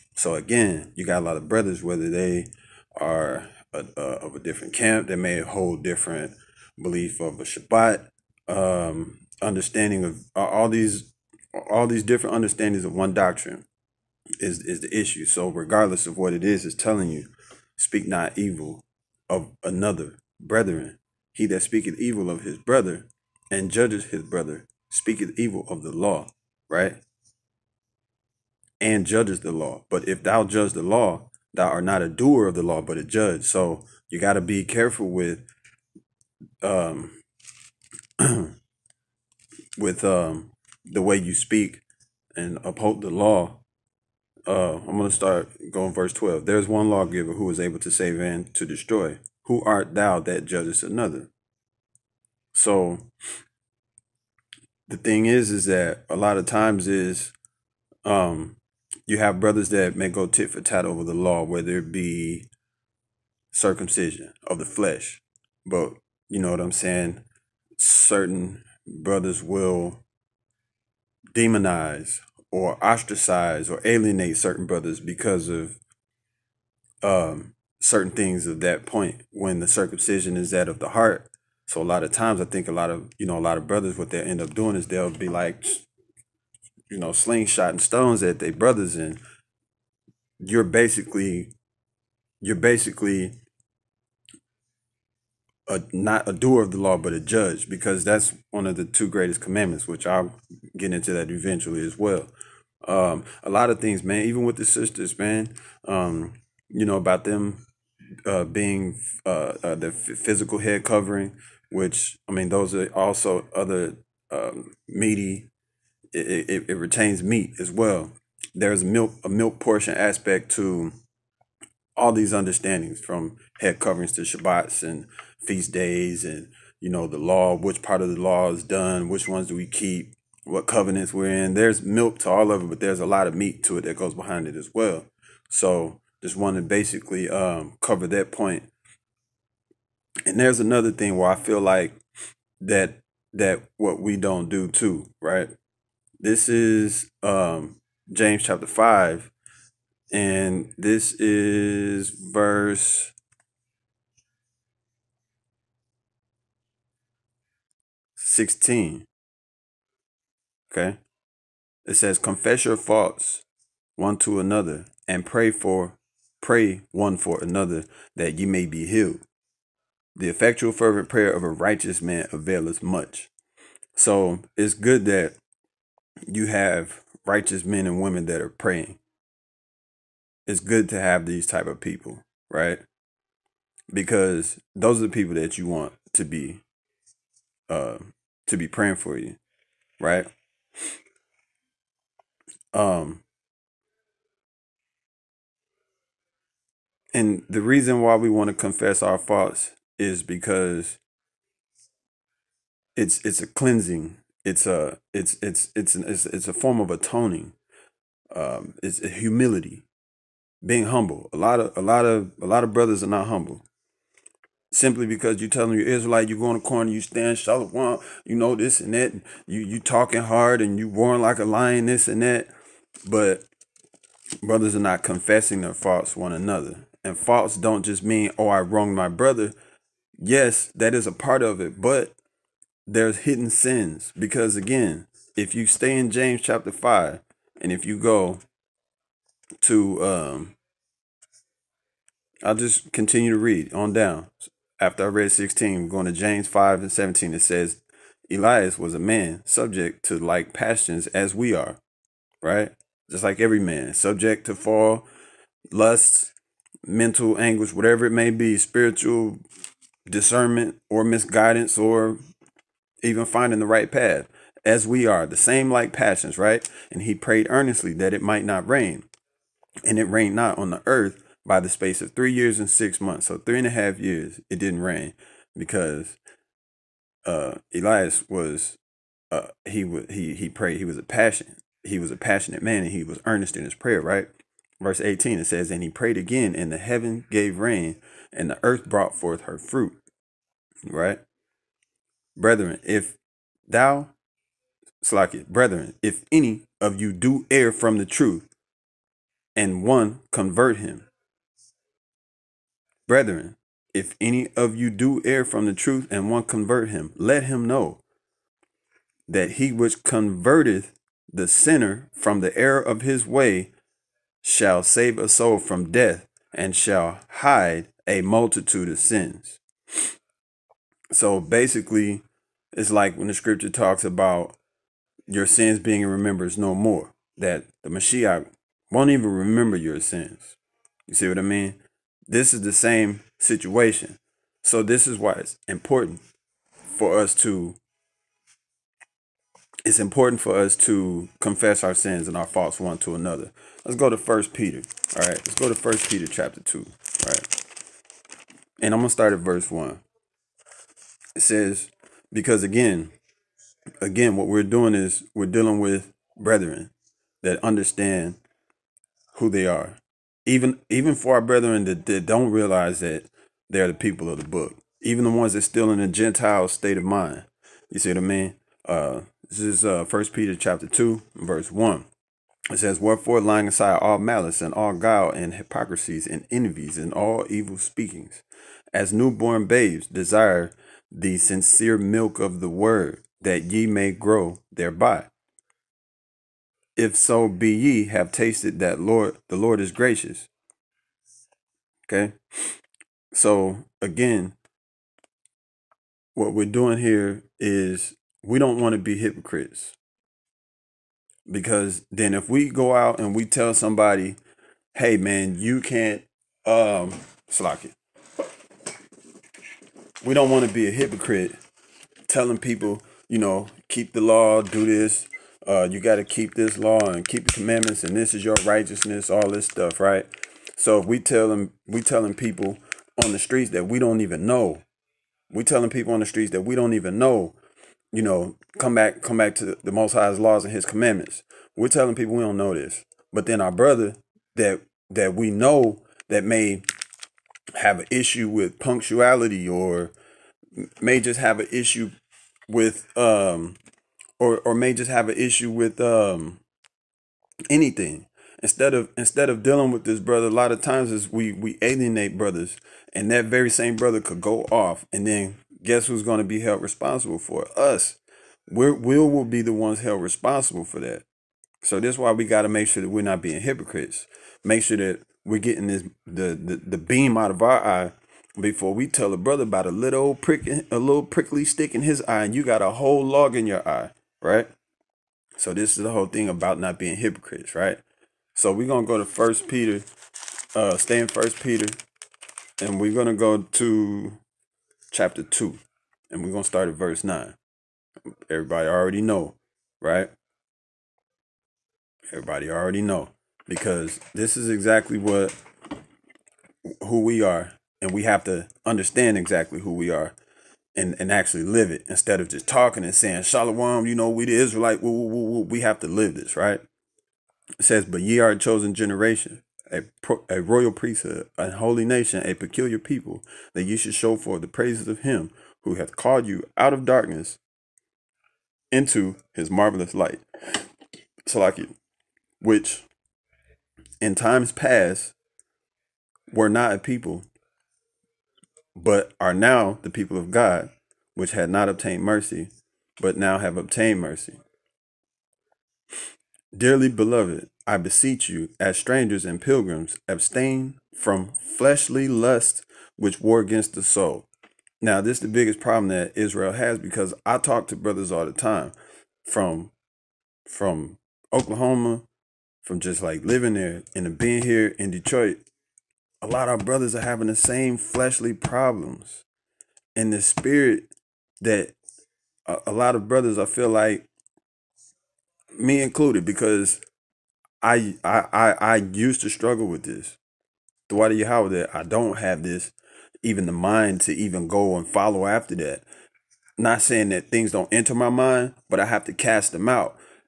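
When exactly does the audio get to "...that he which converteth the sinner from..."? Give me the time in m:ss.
5:09.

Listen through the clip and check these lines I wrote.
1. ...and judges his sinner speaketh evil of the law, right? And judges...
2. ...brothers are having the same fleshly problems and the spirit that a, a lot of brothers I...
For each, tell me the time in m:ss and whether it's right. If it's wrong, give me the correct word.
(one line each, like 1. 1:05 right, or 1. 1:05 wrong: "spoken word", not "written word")
1. 0:23 wrong: "brother", not "sinner"
2. 9:16 right.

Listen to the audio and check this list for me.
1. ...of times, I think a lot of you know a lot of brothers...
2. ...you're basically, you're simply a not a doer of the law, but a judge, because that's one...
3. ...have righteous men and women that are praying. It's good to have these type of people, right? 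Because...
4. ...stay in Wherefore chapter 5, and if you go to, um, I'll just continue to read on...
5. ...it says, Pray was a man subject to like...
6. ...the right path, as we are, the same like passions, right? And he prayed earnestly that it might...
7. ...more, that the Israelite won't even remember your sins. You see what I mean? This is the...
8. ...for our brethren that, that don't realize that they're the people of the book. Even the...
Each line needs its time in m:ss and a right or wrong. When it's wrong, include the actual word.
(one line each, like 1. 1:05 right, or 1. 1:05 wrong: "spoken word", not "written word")
1. 1:22 right
2. 1:30 wrong: "basically", not "simply"
3. 2:56 right
4. 3:55 wrong: "James", not "Wherefore"
5. 4:07 wrong: "Elias", not "Pray"
6. 4:23 right
7. 5:26 wrong: "Mashiach", not "Israelite"
8. 6:01 right.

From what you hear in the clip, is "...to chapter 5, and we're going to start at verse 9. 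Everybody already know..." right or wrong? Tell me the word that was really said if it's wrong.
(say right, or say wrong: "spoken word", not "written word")
wrong: "2", not "5".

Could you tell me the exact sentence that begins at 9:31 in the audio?
Throughout the how that I don't have this, even the mind to even go and follow after that.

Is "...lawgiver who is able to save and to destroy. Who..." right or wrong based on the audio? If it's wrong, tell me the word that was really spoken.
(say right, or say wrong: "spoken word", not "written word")
right.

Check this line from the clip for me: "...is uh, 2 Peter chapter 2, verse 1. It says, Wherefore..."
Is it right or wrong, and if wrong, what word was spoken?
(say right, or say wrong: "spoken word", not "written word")
wrong: "1", not "2".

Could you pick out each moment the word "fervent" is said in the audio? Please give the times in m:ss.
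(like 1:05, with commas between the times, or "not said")
2:50.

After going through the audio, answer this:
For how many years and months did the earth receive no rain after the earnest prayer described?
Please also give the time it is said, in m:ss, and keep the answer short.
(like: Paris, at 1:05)
3 years and 6 months, at 4:32.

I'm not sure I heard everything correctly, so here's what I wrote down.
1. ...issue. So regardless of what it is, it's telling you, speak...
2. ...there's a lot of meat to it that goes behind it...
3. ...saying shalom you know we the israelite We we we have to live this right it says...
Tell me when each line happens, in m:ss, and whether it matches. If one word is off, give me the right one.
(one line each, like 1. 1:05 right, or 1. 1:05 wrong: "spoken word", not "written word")
1. 0:14 right
2. 2:12 right
3. 8:23 right.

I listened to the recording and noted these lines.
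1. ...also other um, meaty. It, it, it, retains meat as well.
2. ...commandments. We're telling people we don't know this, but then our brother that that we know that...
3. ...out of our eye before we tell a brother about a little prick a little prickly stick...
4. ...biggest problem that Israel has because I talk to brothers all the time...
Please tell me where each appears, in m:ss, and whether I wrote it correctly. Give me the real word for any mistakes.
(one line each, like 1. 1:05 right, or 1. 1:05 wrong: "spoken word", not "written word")
1. 1:52 right
2. 7:10 right
3. 7:47 right
4. 9:05 right.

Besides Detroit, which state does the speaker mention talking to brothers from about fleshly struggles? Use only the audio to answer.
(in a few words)
Oklahoma.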